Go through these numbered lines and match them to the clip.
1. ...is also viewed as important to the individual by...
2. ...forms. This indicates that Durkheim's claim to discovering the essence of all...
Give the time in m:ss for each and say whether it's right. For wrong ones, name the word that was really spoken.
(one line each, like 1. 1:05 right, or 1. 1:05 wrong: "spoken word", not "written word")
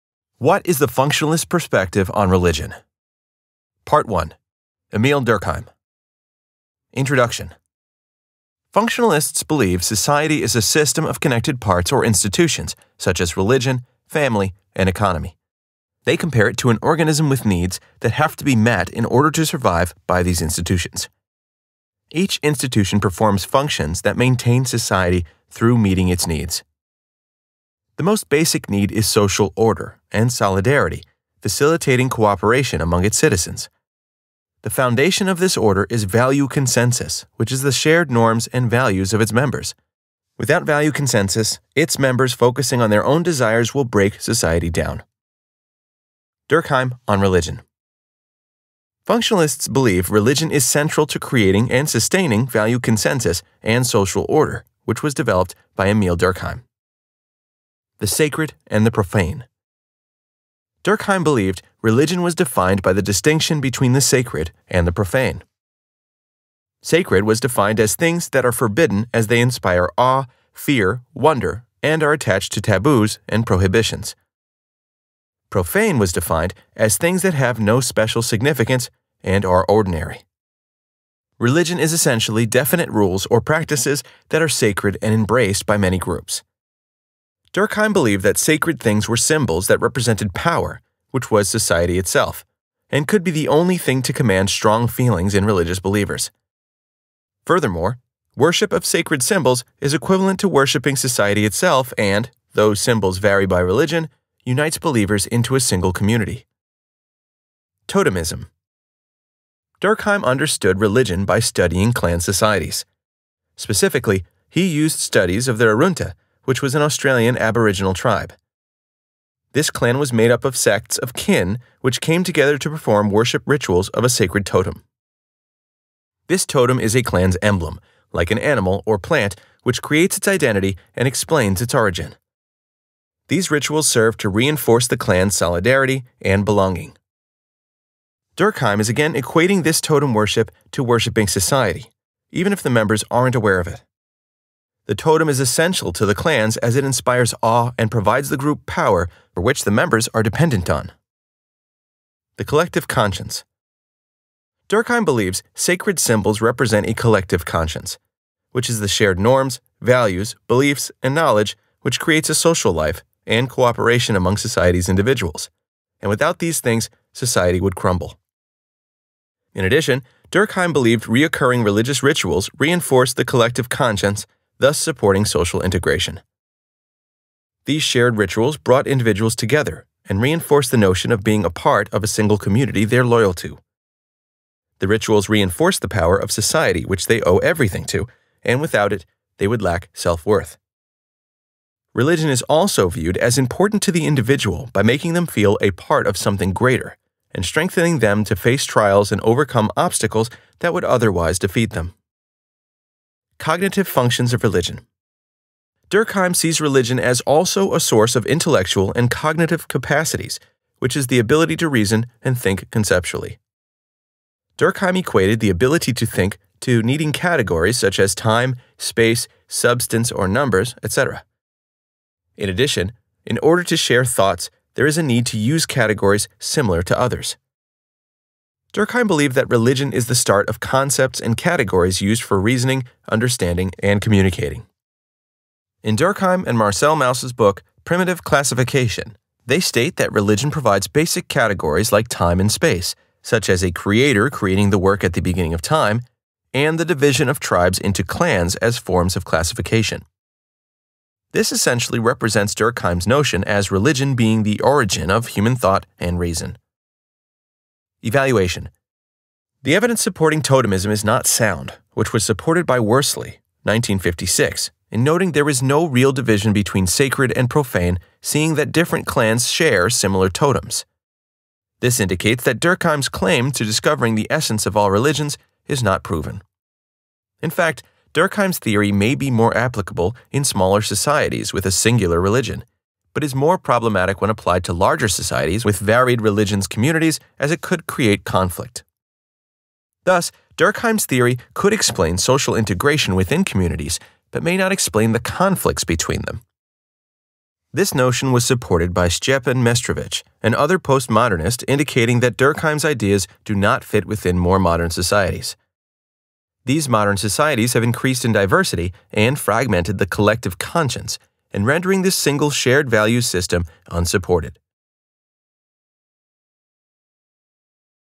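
1. 3:12 right
2. 4:30 wrong: "totems", not "forms".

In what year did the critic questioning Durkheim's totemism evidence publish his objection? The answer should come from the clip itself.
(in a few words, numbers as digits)
1956.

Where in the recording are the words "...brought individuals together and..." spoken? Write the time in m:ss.
2:58.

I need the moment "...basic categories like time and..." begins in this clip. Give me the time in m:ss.
4:00.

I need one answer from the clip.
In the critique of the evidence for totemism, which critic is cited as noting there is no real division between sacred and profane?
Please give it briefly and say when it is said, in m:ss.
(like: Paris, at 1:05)
Worsley, at 4:22.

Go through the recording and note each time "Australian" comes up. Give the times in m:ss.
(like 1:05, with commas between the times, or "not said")
1:56.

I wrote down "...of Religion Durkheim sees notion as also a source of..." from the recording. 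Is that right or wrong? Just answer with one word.
wrong.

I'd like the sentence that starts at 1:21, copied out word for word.
Religion is essentially definite rules or practices that are sacred and embraced by many groups.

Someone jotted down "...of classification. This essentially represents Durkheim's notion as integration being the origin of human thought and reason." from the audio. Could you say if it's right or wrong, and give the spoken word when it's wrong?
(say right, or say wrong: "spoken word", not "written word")
wrong: "religion", not "integration".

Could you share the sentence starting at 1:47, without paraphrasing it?
Totemism Durkheim understood religion by studying clan societies.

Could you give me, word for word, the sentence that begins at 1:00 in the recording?
Durkheim believed religion was defined by the distinction between the sacred and the profane.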